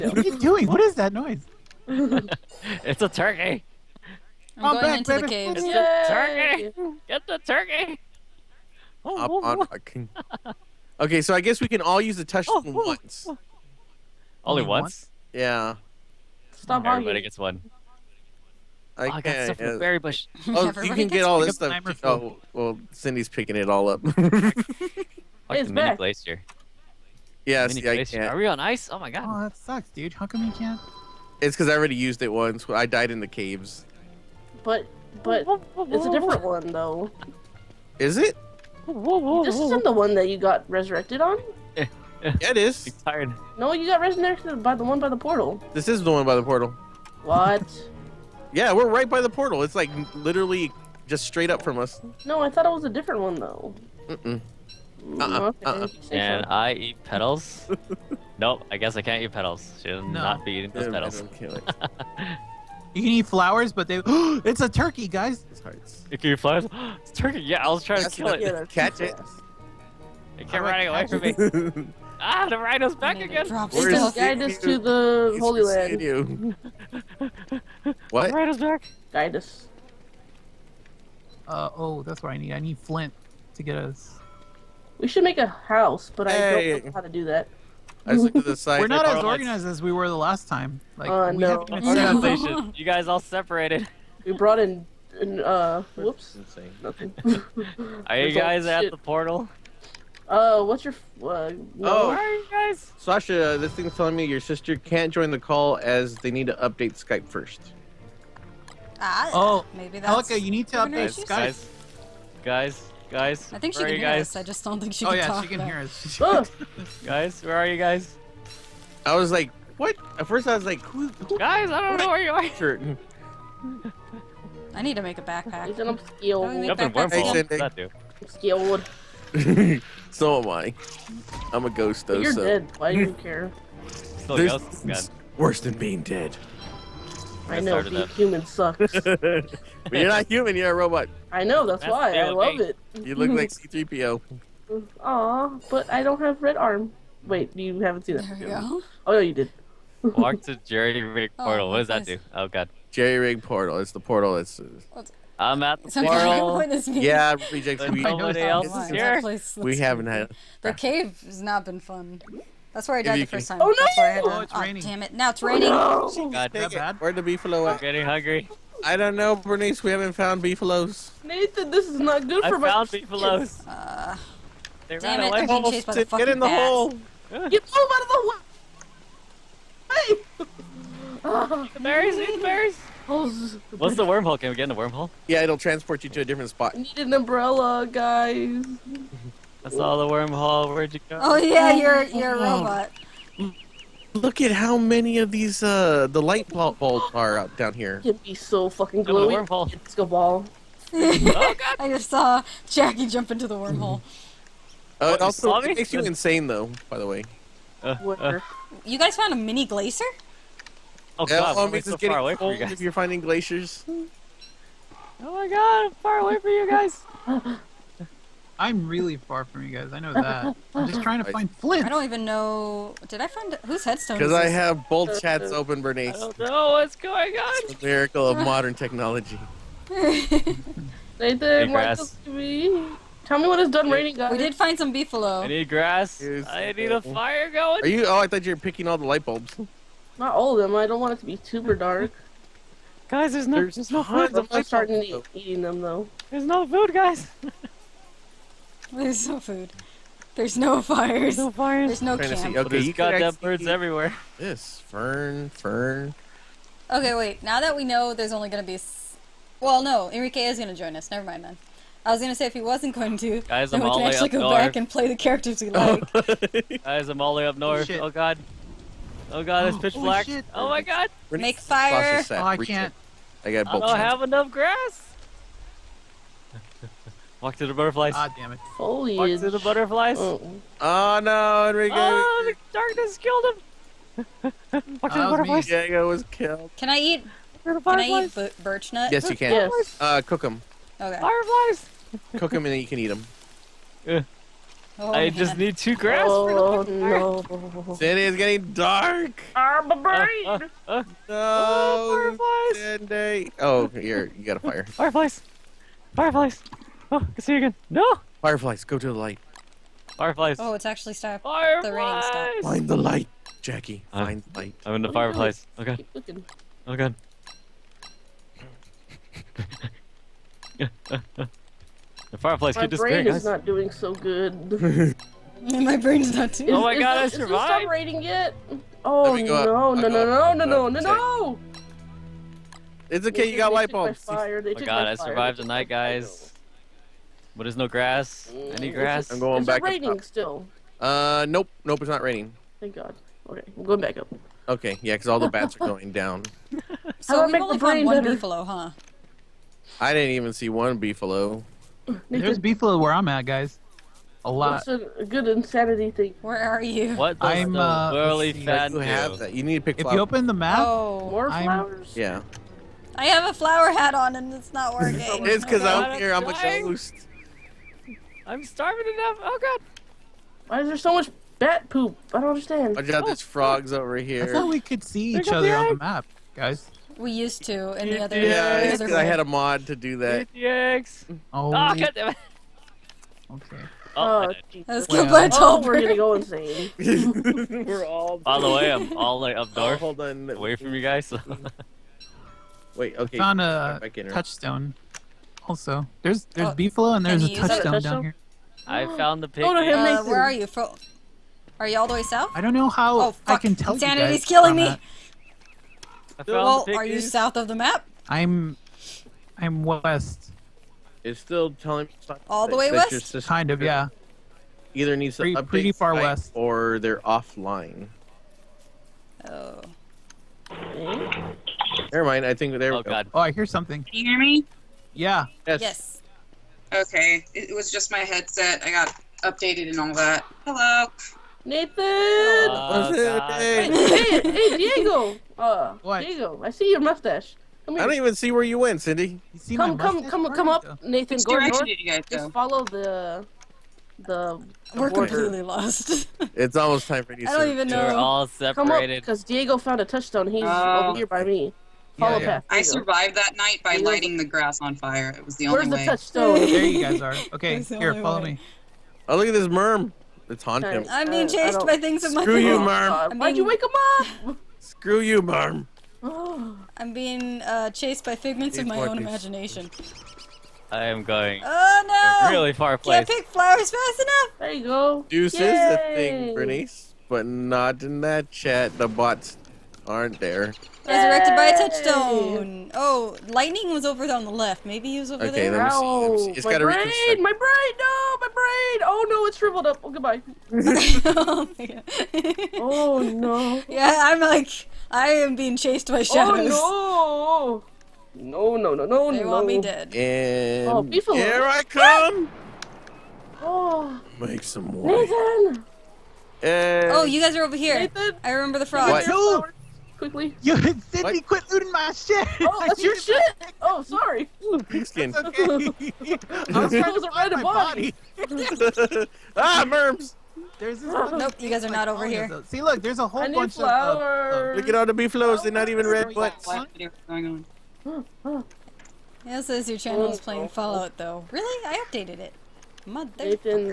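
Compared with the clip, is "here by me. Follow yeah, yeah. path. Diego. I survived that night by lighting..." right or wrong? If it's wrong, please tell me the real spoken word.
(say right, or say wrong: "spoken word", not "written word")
right.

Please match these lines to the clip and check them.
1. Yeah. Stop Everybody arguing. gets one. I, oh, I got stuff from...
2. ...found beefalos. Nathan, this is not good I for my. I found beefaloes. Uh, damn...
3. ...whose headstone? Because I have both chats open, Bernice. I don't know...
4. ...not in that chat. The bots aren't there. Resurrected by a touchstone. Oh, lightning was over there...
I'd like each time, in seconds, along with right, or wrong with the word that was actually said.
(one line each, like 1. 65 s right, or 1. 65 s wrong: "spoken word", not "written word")
1. 15 s right
2. 170 s right
3. 223 s right
4. 477 s right.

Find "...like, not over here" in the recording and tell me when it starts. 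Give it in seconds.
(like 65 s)
521 s.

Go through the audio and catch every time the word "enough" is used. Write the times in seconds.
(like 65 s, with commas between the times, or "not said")
274 s, 369 s, 474 s.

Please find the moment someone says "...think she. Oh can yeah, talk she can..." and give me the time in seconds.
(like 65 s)
114 s.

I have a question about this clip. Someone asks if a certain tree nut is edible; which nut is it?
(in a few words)
birch nut.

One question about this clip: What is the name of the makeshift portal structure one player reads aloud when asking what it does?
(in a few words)
Jerry Rig portal.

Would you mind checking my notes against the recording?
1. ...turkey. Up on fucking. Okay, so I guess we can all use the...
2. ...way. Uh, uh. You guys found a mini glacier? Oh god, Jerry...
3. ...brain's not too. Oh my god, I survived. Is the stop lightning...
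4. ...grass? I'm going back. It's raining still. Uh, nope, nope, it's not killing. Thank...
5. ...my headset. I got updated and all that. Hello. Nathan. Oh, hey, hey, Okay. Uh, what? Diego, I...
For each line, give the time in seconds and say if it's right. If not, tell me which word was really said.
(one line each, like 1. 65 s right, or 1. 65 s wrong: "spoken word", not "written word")
1. 7 s right
2. 207 s wrong: "Elm", not "Jerry"
3. 325 s wrong: "rating", not "lightning"
4. 338 s wrong: "raining", not "killing"
5. 428 s wrong: "Diego", not "Okay".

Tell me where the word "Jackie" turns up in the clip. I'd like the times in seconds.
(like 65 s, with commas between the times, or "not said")
202 s, 313 s.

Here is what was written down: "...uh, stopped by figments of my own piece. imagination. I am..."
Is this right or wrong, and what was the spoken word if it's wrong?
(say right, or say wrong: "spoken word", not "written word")
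wrong: "chased", not "stopped".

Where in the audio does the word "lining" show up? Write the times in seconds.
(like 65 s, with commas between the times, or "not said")
not said.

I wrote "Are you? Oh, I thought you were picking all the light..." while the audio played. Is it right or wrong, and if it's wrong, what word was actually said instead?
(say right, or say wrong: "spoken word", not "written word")
right.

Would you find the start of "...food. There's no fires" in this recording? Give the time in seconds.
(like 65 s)
249 s.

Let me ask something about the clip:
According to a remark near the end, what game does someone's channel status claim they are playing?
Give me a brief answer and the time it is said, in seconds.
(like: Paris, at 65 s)
Fallout, at 530 s.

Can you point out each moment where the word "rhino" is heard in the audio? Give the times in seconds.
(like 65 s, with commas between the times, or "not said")
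72 s, 78 s.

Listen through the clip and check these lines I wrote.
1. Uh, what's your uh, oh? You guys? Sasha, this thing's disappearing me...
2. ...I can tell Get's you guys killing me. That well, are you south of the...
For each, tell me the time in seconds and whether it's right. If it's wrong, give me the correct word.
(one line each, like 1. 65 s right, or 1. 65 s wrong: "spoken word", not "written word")
1. 100 s wrong: "telling", not "disappearing"
2. 403 s wrong: "Insanity", not "Get".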